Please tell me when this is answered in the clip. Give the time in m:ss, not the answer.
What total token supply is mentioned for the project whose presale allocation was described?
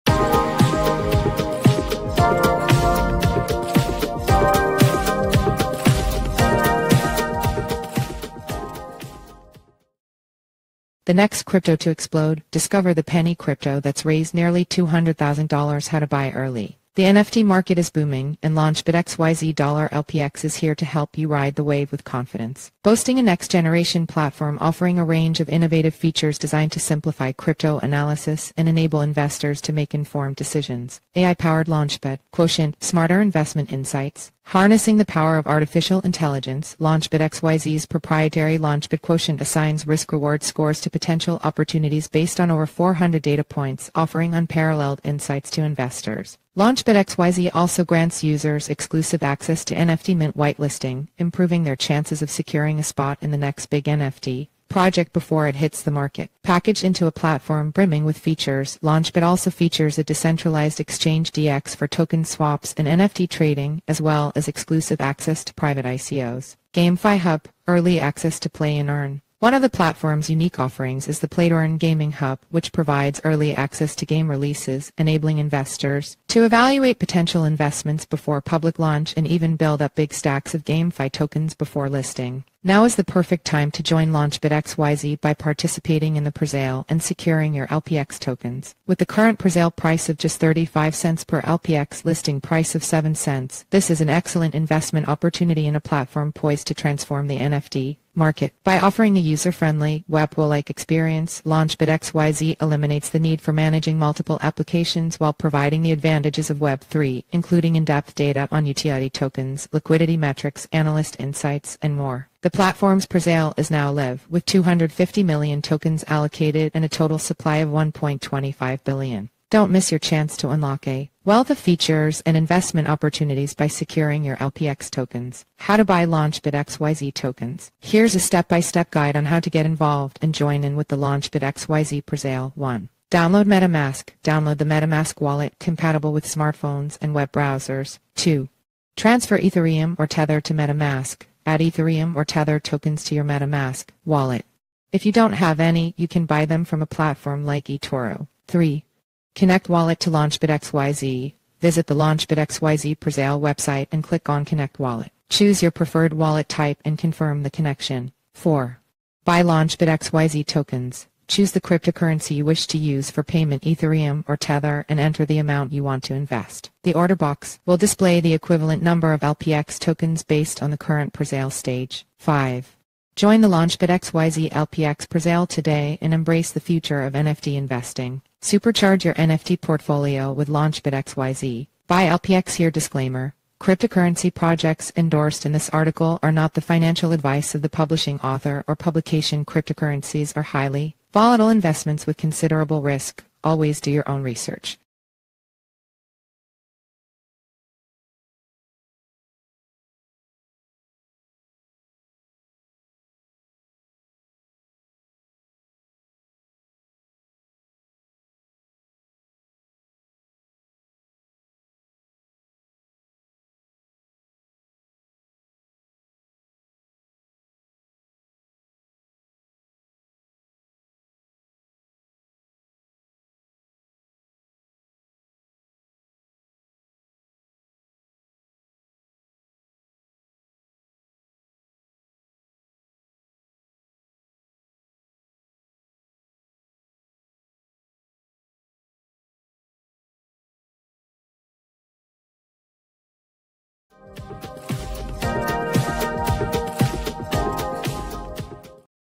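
1:57.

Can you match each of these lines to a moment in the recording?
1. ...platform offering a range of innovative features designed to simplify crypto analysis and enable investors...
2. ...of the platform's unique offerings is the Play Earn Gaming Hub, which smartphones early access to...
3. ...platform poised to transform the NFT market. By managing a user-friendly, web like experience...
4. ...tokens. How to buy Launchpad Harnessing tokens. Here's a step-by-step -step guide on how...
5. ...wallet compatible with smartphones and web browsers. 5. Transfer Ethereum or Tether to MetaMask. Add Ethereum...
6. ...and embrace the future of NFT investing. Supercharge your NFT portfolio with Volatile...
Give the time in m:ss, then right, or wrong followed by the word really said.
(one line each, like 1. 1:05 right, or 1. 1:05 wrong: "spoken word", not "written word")
1. 0:24 right
2. 1:09 wrong: "provides", not "smartphones"
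3. 1:35 wrong: "offering", not "managing"
4. 2:04 wrong: "XYZ", not "Harnessing"
5. 2:15 wrong: "2", not "5"
6. 2:56 wrong: "Launchpad", not "Volatile".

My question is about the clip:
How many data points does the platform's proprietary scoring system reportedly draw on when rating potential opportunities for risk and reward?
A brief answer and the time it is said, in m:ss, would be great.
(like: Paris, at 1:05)
over 400, at 0:42.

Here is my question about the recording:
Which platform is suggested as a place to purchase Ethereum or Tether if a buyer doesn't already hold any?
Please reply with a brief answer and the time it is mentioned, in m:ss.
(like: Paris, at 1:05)
eToro, at 2:27.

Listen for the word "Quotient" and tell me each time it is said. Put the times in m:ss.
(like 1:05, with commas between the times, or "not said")
0:32, 0:39.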